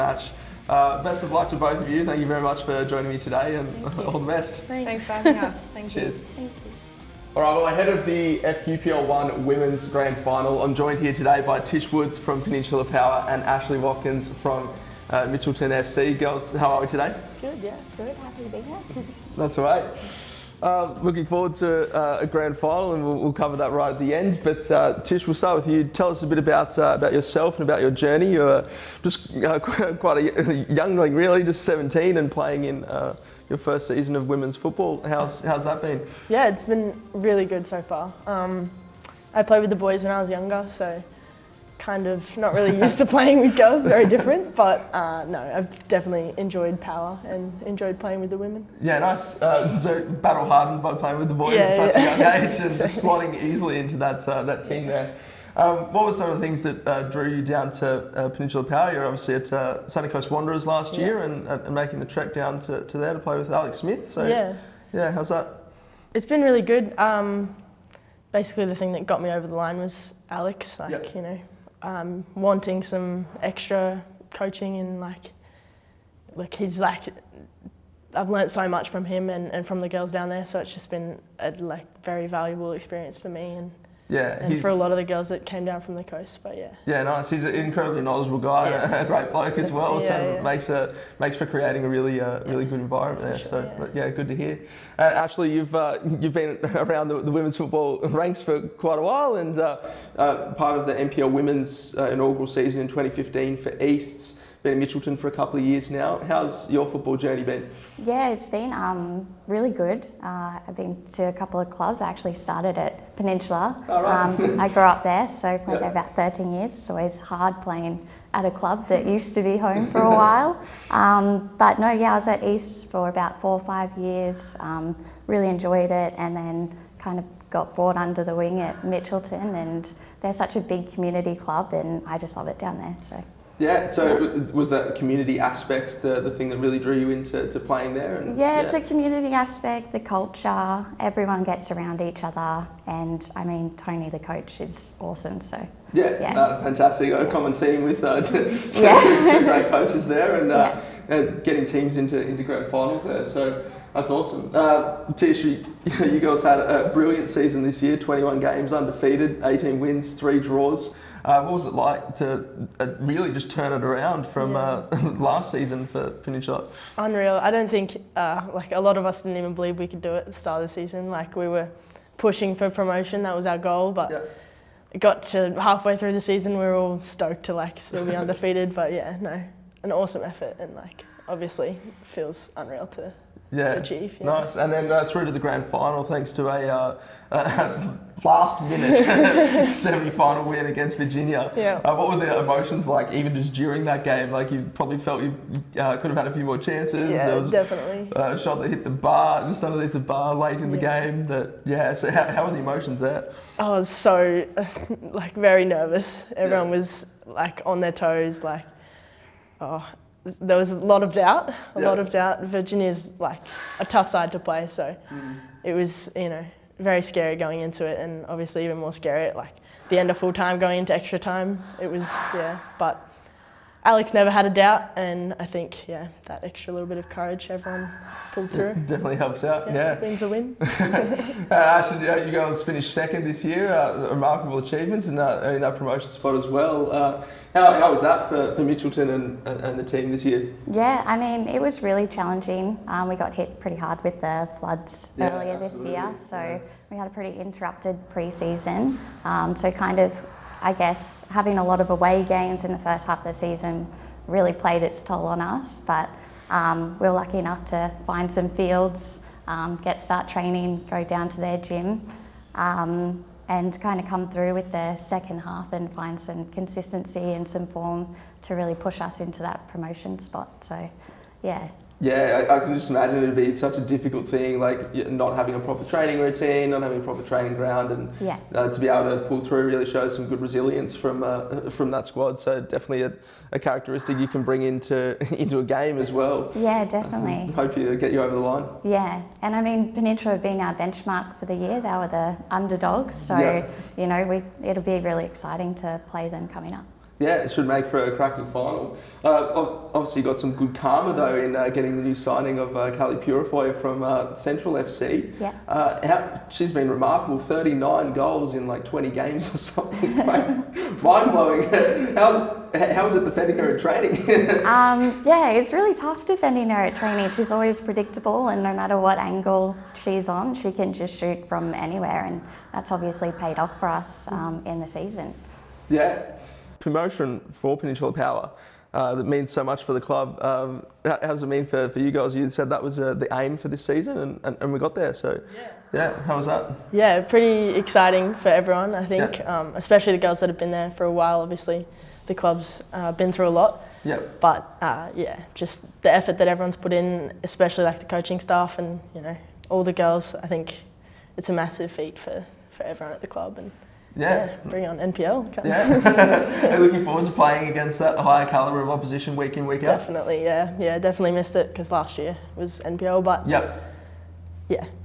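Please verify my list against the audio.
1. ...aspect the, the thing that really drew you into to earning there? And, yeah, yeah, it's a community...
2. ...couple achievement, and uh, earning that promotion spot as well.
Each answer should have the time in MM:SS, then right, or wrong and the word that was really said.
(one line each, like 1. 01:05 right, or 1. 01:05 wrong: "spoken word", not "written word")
1. 02:15 wrong: "playing", not "earning"
2. 03:54 wrong: "remarkable", not "couple".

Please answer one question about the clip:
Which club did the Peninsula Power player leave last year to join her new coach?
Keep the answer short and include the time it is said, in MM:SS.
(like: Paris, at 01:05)
Sunny Coast Wanderers, at 00:59.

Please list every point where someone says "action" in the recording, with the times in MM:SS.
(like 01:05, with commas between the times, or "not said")
not said.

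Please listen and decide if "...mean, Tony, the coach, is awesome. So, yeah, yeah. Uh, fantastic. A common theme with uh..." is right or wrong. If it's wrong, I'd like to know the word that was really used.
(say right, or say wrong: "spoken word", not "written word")
right.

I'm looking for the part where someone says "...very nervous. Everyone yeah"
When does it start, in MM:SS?
03:25.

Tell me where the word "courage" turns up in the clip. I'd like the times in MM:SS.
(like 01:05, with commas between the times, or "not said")
03:47.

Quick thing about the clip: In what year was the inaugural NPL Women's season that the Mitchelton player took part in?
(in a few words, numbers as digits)
2015.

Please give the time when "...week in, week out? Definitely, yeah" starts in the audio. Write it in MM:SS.
05:59.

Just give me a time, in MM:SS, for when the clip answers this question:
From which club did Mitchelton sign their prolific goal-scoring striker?
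05:04.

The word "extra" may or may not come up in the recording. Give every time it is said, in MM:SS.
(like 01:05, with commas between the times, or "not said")
01:13, 03:40, 03:46.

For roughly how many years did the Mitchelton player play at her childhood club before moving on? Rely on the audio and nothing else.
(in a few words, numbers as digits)
13.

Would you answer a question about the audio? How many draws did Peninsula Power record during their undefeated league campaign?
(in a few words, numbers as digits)
3.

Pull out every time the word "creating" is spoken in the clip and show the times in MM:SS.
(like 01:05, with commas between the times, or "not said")
01:31.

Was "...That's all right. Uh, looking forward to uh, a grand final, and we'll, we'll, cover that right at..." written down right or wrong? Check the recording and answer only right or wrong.
right.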